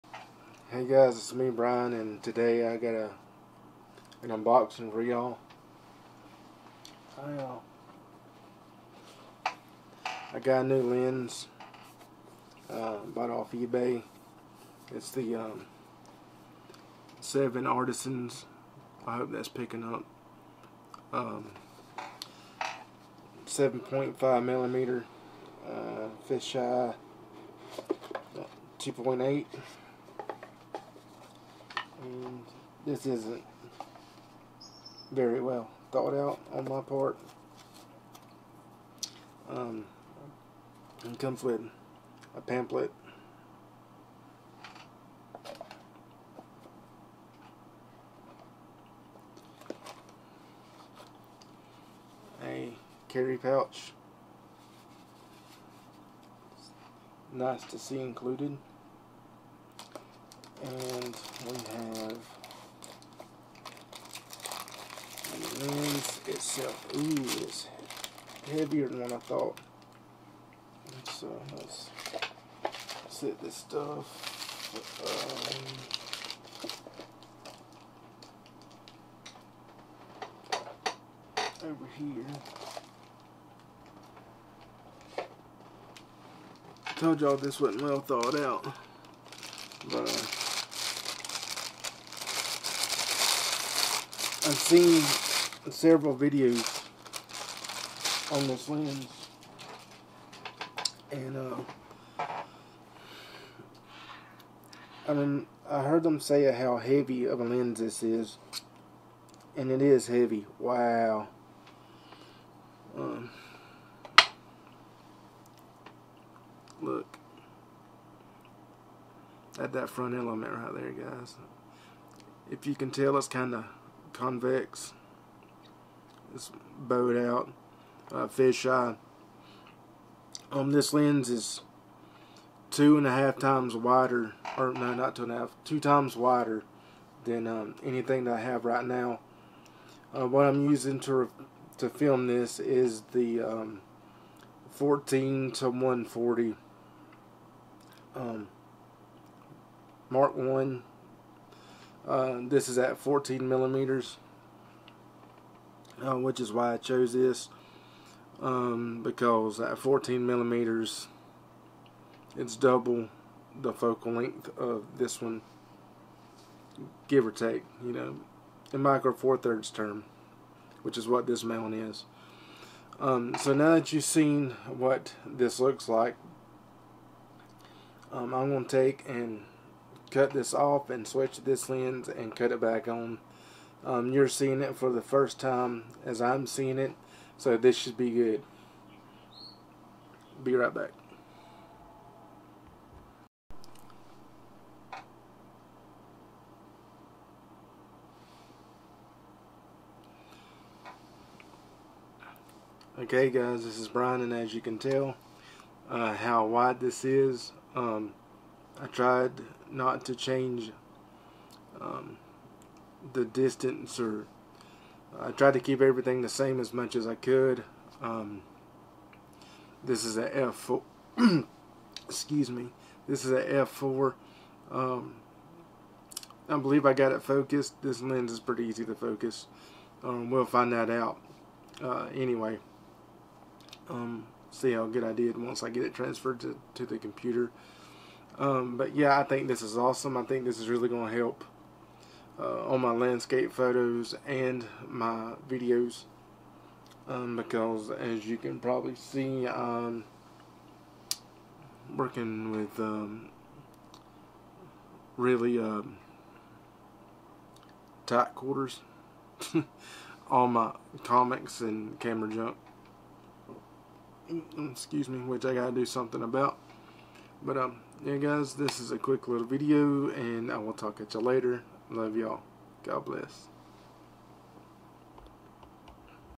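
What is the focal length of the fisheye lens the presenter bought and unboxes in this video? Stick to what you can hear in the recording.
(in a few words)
7.5mm.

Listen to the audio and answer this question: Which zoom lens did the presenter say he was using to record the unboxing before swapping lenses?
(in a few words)
14-140mm Mark One.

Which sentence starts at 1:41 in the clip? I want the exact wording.
And uh, I mean, I heard them say how heavy of a lens this is.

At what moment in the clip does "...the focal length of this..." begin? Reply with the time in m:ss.
2:43.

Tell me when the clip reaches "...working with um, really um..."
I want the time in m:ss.
4:11.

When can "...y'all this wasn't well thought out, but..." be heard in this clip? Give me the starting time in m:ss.
1:27.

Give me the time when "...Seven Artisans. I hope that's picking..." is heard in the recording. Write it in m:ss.
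0:17.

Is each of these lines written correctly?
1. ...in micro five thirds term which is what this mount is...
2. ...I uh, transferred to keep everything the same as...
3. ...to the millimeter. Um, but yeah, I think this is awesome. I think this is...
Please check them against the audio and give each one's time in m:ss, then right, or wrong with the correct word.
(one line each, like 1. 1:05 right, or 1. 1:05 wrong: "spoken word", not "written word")
1. 2:48 wrong: "four", not "five"
2. 3:35 wrong: "tried", not "transferred"
3. 3:56 wrong: "computer", not "millimeter".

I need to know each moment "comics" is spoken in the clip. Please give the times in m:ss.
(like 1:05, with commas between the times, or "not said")
4:21.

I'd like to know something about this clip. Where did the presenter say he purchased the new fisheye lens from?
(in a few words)
eBay.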